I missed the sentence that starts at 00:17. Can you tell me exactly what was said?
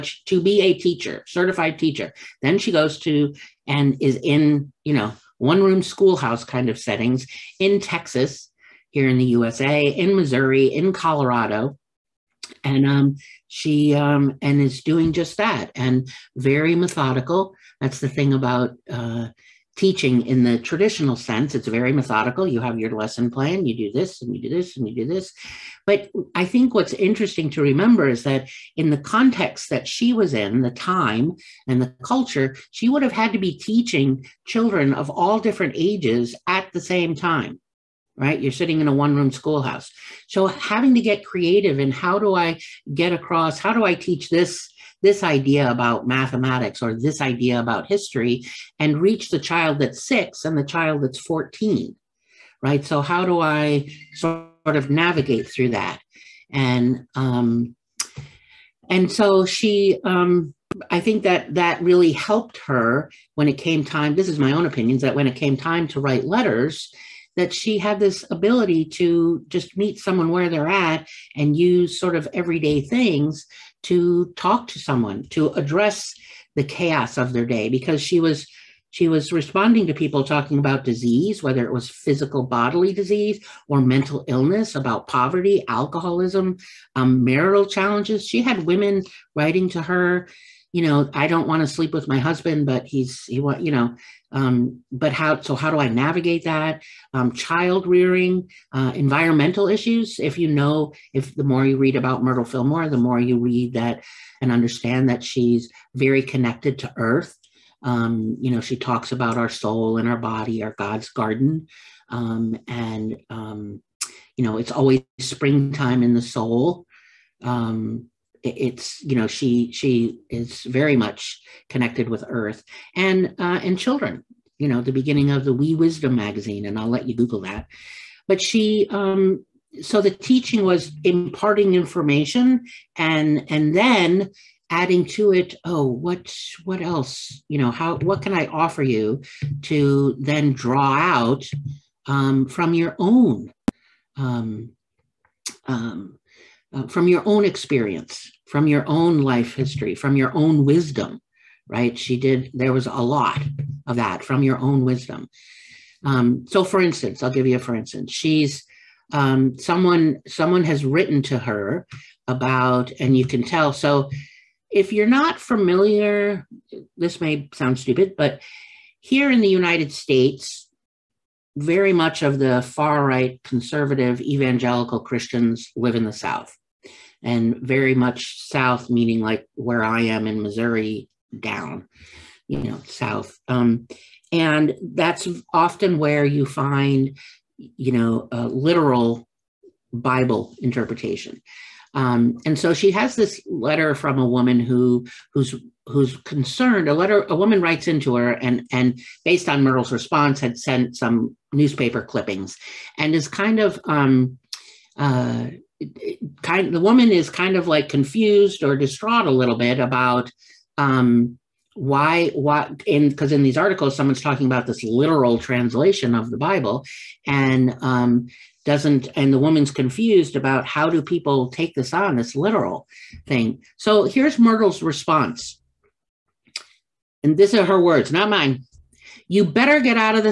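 That's the thing about uh, teaching in the traditional sense.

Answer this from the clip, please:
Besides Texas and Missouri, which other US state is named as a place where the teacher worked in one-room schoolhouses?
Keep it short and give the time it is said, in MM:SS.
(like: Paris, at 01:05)
Colorado, at 00:10.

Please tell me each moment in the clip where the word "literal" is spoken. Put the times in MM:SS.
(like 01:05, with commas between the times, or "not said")
03:08, 03:34, 03:42.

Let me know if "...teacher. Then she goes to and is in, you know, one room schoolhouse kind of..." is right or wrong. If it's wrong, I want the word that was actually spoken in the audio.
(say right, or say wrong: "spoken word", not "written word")
right.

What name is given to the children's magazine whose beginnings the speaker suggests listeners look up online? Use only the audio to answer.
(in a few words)
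Wee Wisdom.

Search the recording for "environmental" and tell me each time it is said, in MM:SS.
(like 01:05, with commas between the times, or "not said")
01:38.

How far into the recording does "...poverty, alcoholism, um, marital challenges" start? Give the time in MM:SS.
01:25.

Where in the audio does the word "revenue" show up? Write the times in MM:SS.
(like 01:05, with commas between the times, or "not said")
not said.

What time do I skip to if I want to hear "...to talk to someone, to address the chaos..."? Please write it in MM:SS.
01:13.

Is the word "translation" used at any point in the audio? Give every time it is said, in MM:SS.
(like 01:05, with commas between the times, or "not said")
03:35.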